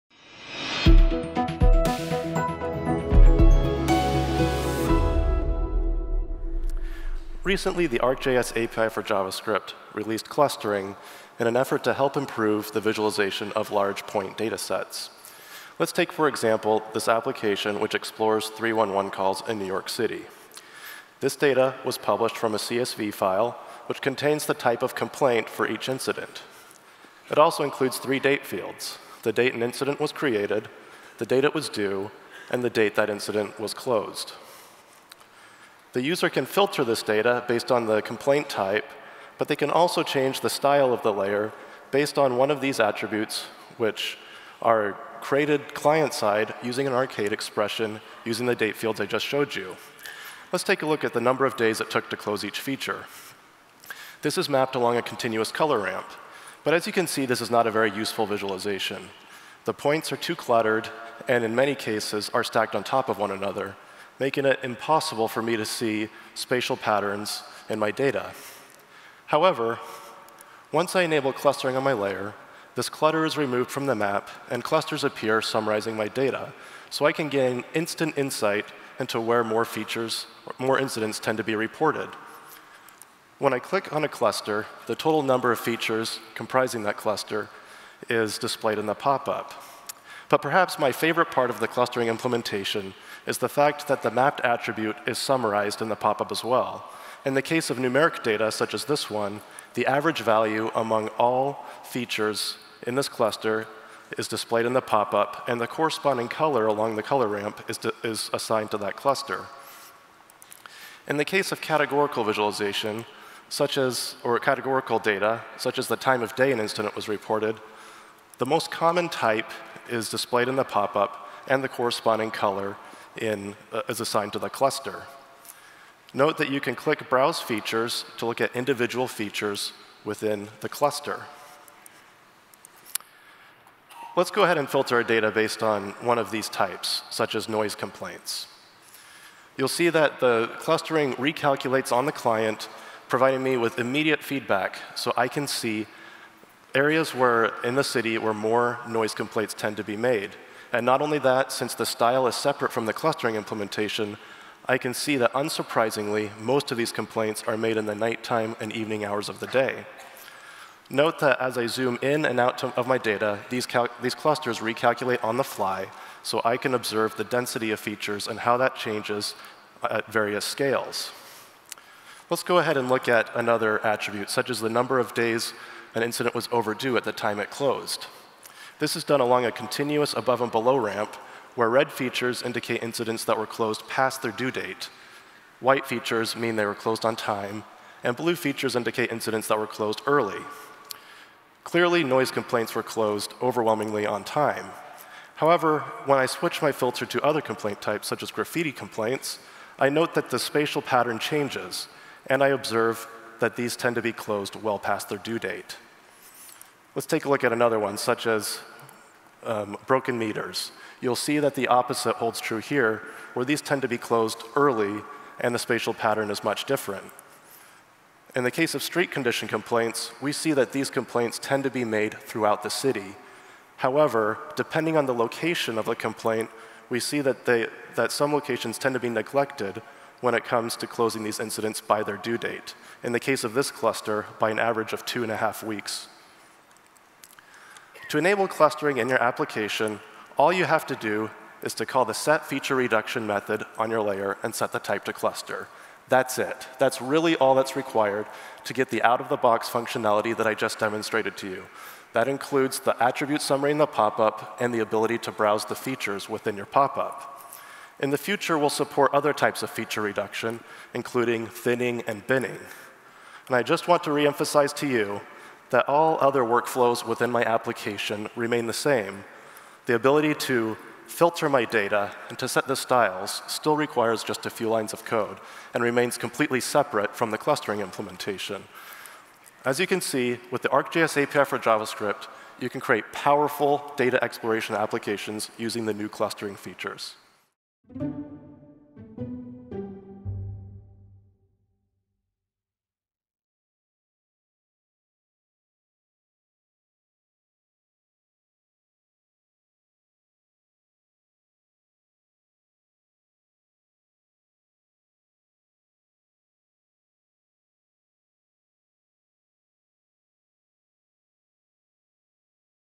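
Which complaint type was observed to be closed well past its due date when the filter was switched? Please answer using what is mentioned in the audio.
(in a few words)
graffiti complaints.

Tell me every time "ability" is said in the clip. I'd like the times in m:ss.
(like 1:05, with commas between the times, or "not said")
4:14, 4:29.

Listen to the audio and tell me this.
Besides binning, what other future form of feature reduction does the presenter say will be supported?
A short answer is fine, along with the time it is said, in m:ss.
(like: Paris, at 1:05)
thinning, at 4:21.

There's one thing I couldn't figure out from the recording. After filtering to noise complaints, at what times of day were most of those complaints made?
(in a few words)
nighttime and evening.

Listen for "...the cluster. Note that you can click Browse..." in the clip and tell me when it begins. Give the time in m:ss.
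2:04.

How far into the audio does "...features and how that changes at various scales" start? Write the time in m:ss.
2:47.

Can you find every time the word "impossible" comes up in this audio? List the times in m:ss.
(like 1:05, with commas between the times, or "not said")
1:04.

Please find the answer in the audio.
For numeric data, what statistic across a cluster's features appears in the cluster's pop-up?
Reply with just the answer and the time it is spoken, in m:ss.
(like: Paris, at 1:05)
average value, at 1:39.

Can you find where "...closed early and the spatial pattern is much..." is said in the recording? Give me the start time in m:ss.
3:33.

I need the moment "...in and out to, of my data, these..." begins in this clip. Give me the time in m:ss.
2:42.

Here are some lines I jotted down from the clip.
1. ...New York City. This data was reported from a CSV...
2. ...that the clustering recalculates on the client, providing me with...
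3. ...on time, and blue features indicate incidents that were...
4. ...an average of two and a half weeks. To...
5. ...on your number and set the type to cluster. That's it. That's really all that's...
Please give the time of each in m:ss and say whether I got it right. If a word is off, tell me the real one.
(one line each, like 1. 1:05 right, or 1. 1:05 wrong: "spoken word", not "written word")
1. 0:19 wrong: "published", not "reported"
2. 2:19 right
3. 3:07 right
4. 3:54 right
5. 4:03 wrong: "layer", not "number".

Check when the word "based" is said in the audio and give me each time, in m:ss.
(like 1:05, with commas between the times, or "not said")
0:37, 0:41, 2:15.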